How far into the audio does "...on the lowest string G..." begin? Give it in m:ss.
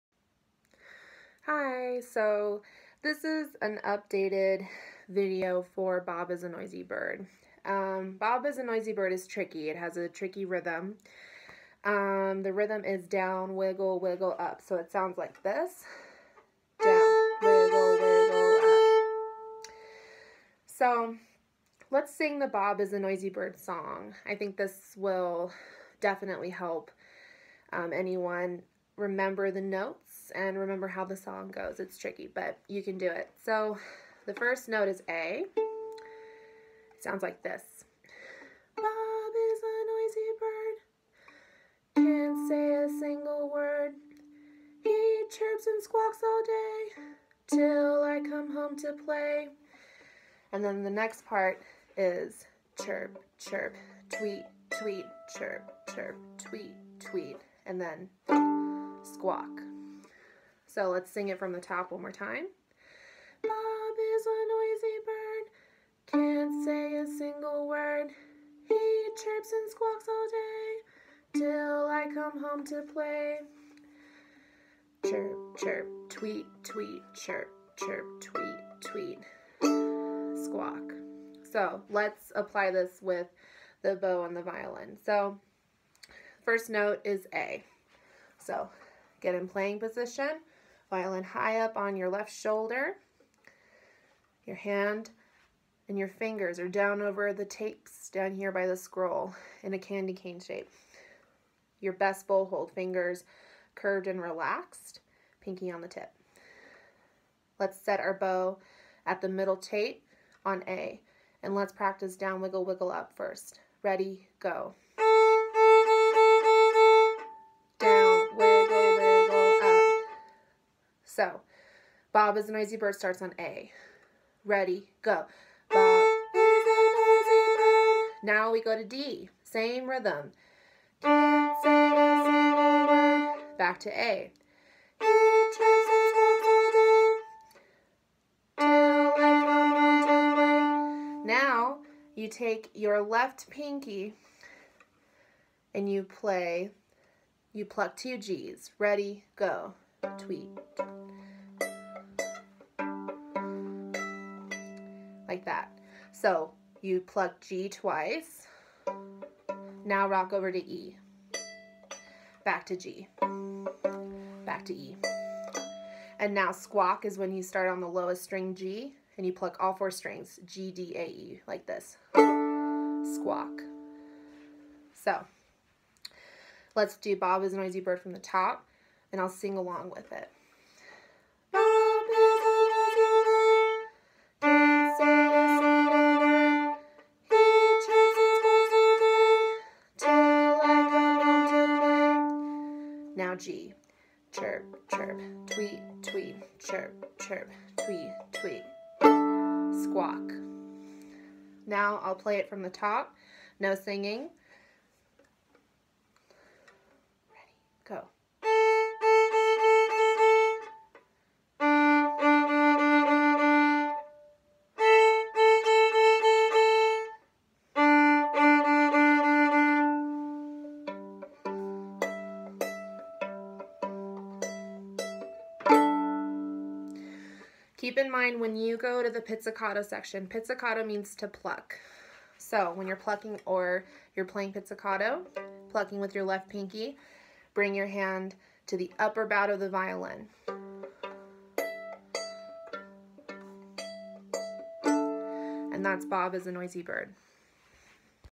2:47.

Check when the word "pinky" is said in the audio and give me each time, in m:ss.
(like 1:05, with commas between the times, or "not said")
1:45, 2:23, 3:56.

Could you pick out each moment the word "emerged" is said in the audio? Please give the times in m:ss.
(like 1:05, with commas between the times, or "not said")
not said.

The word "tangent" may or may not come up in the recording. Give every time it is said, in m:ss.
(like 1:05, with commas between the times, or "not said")
not said.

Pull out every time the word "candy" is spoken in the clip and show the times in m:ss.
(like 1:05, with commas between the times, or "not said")
1:39.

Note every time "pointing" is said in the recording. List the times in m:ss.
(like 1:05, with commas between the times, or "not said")
not said.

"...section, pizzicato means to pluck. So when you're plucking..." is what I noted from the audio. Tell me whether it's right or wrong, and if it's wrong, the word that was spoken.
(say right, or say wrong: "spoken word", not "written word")
right.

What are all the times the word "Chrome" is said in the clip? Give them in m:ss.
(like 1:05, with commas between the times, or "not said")
not said.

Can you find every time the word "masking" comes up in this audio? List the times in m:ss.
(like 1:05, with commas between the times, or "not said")
not said.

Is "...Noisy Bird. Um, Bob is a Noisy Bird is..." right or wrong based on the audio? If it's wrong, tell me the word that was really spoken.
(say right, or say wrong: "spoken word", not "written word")
right.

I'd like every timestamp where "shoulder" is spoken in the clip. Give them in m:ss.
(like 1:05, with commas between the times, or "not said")
1:32.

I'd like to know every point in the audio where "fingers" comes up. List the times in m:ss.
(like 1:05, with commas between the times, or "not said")
1:36, 1:42.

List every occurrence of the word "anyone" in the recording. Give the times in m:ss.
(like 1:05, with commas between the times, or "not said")
0:27.